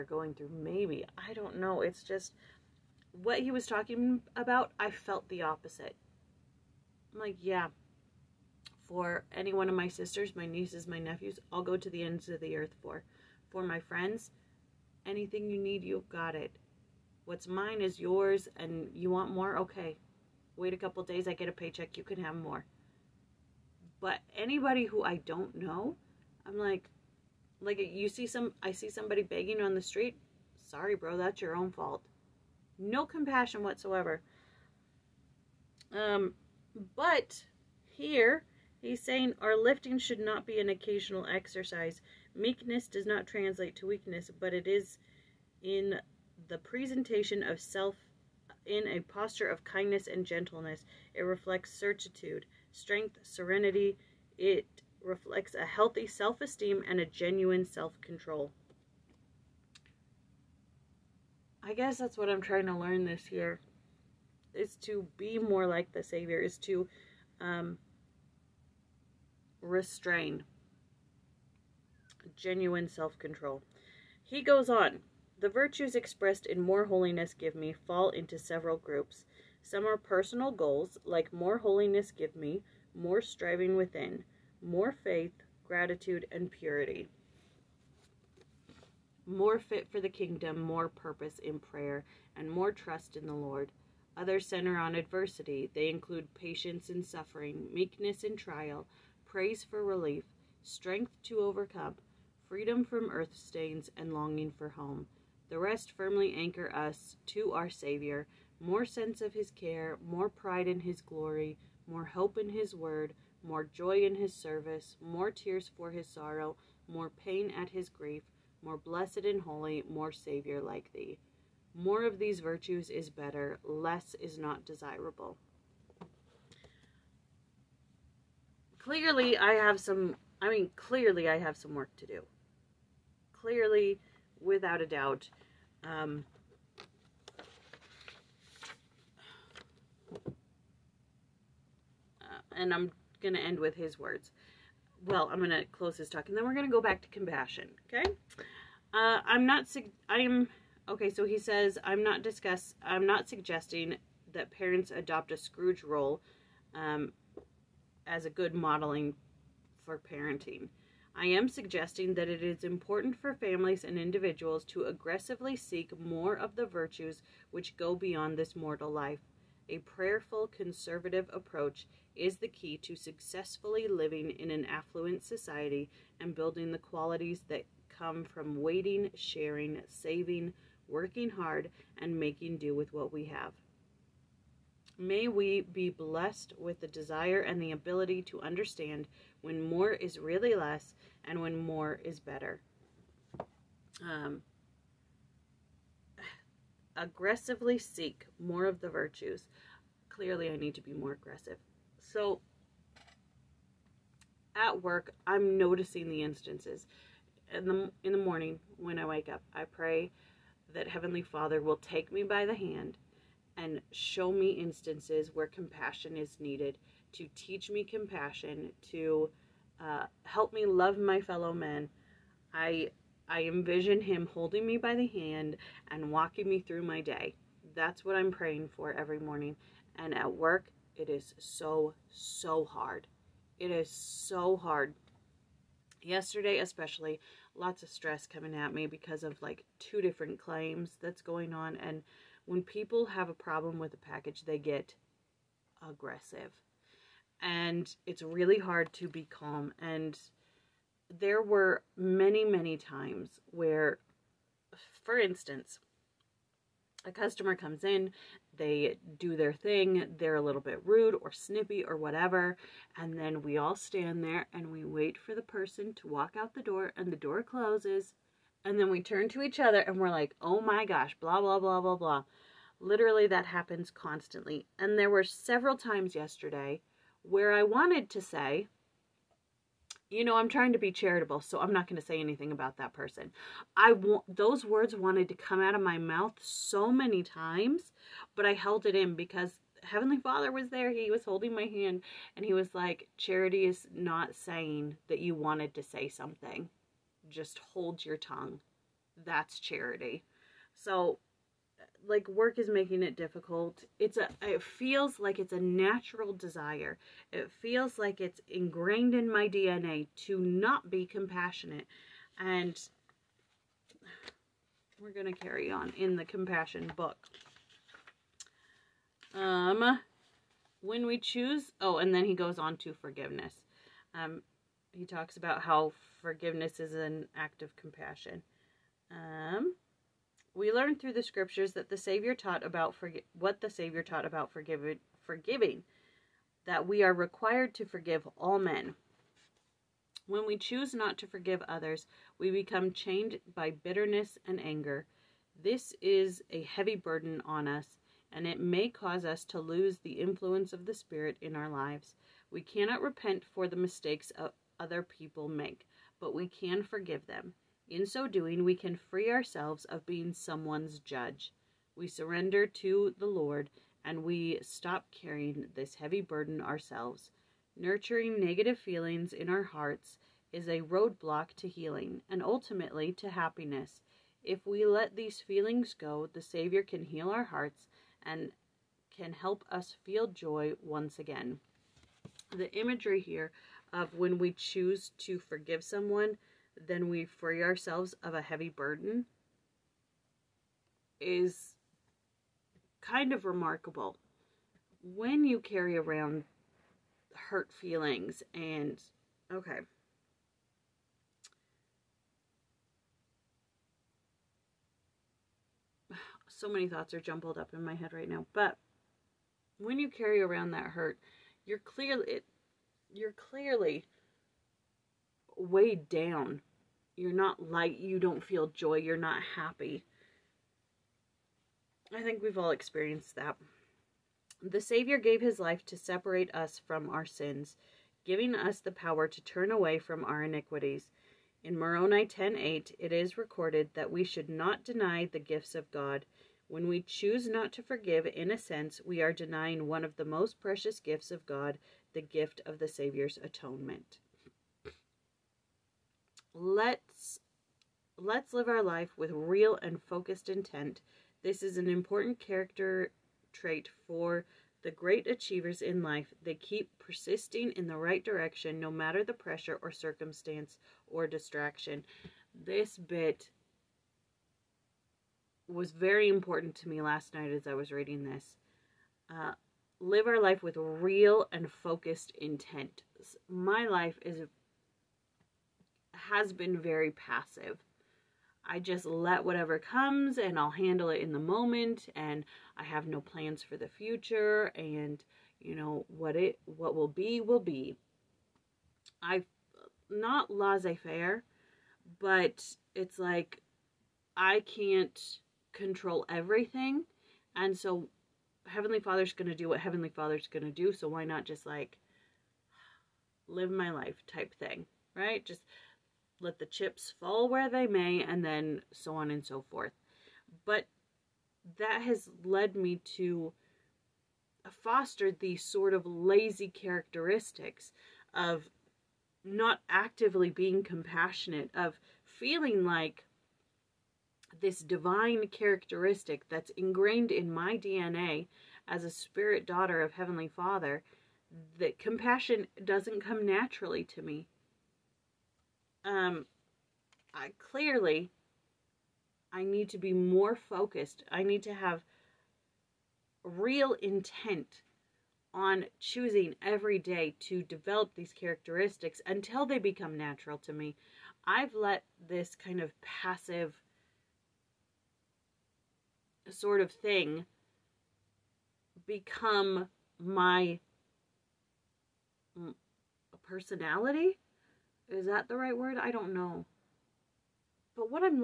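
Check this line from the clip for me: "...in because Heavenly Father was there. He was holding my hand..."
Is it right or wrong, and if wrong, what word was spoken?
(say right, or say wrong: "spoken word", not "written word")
right.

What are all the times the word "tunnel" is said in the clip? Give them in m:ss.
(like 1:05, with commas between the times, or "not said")
not said.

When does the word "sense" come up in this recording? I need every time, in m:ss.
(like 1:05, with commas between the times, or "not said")
1:48, 7:18.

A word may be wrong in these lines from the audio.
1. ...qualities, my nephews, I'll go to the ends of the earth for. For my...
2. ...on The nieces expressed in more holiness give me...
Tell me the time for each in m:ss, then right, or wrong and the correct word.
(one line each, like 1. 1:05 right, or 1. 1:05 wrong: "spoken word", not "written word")
1. 0:10 wrong: "nieces", not "qualities"
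2. 1:14 wrong: "virtues", not "nieces".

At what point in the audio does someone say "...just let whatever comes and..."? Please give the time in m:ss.
7:58.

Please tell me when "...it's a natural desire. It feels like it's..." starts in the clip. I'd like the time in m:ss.
5:05.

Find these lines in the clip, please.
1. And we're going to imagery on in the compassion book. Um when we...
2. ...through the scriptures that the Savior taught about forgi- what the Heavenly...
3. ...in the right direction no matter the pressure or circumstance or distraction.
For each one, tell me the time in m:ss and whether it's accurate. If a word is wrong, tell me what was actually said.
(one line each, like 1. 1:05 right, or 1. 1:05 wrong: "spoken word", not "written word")
1. 5:12 wrong: "carry", not "imagery"
2. 5:30 wrong: "Savior", not "Heavenly"
3. 7:37 right.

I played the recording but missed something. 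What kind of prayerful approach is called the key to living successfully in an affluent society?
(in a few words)
conservative.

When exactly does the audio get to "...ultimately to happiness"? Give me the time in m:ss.
6:12.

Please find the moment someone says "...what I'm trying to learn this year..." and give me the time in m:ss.
1:02.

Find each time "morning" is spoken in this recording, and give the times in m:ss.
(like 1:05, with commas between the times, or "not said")
3:28, 3:49.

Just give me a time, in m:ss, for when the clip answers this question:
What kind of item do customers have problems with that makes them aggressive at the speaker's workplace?
4:03.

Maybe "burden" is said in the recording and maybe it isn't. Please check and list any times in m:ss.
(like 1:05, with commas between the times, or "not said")
5:46, 6:06, 6:28.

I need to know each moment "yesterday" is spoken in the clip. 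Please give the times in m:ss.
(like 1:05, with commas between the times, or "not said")
3:56, 4:36.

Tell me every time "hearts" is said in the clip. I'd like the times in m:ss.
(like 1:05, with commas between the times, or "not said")
6:09, 6:17.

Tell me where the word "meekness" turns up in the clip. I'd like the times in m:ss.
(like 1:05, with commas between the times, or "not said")
0:42, 1:37.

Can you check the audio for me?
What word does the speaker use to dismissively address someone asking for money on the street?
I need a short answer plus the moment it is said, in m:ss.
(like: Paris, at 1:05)
bro, at 0:30.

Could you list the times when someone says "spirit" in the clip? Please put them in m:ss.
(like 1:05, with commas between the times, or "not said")
5:50, 8:49.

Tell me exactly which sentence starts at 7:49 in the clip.
Uh, live our life with real and focused intent.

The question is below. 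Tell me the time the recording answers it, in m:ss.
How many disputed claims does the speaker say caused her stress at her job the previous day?
3:59.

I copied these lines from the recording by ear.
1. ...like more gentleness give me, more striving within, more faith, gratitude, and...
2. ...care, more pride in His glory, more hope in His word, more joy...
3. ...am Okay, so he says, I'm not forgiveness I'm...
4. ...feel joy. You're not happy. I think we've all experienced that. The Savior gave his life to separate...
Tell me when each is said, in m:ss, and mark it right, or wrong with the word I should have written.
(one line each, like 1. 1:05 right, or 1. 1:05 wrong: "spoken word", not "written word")
1. 1:21 wrong: "holiness", not "gentleness"
2. 1:49 right
3. 2:30 wrong: "discuss", not "forgiveness"
4. 6:58 right.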